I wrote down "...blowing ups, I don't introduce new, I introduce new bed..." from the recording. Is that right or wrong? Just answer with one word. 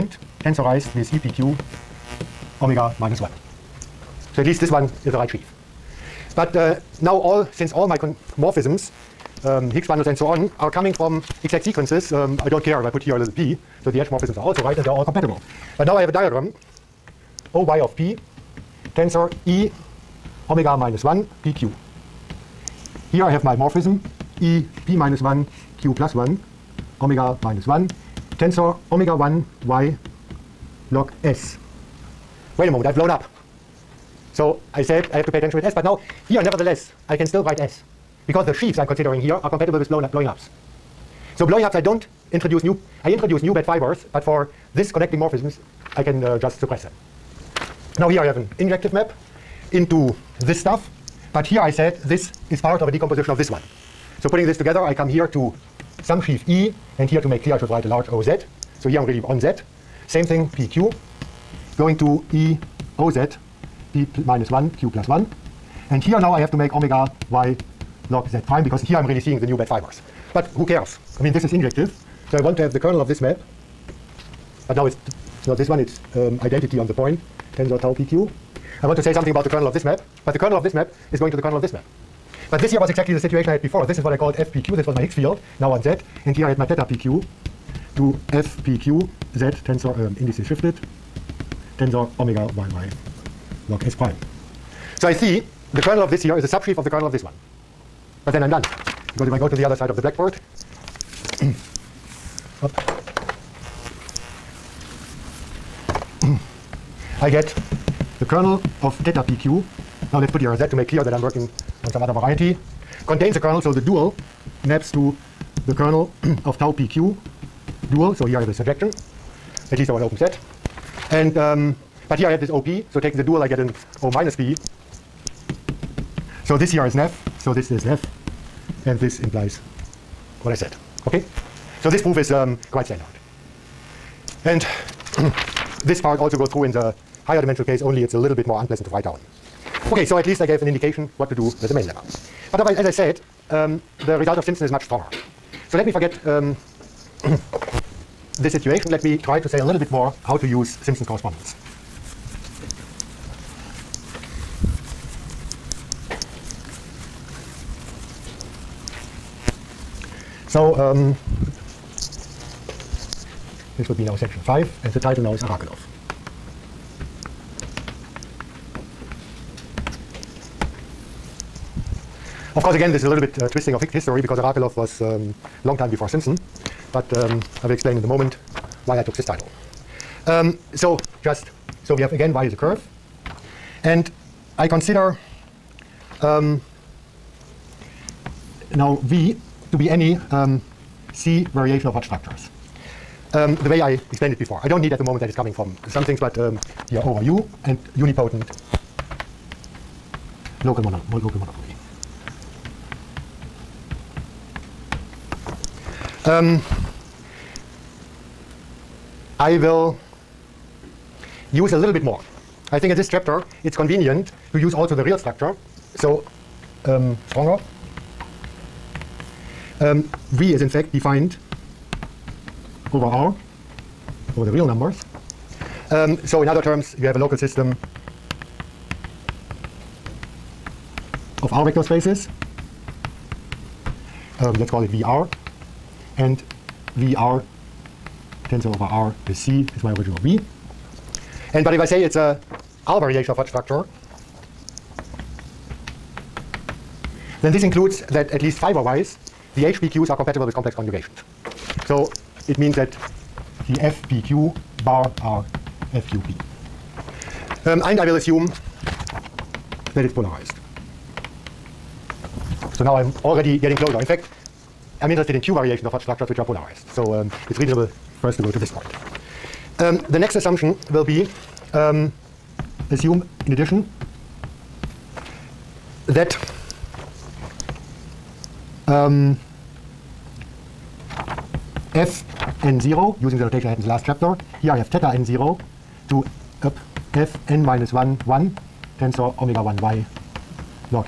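right.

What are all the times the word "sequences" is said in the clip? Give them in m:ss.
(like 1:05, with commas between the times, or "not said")
0:11.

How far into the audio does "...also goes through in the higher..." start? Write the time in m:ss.
2:16.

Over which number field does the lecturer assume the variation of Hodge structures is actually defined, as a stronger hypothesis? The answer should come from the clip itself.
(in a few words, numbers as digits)
The real numbers.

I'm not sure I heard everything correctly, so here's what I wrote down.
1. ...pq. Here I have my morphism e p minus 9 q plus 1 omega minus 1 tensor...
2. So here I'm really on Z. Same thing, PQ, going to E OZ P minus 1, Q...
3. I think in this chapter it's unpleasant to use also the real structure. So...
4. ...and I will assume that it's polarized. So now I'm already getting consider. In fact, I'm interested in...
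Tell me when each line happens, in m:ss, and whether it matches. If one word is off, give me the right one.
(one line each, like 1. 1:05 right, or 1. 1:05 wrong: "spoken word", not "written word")
1. 0:21 wrong: "1", not "9"
2. 0:58 right
3. 3:32 wrong: "convenient", not "unpleasant"
4. 4:17 wrong: "closer", not "consider".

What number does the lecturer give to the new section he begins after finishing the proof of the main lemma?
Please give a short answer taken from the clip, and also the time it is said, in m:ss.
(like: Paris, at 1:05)
5, at 2:44.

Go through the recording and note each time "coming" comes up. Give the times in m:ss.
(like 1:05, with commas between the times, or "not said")
0:10, 3:15.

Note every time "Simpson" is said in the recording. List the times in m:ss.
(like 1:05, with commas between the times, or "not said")
2:24, 2:30, 2:56.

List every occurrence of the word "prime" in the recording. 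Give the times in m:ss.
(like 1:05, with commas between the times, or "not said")
1:08, 1:33.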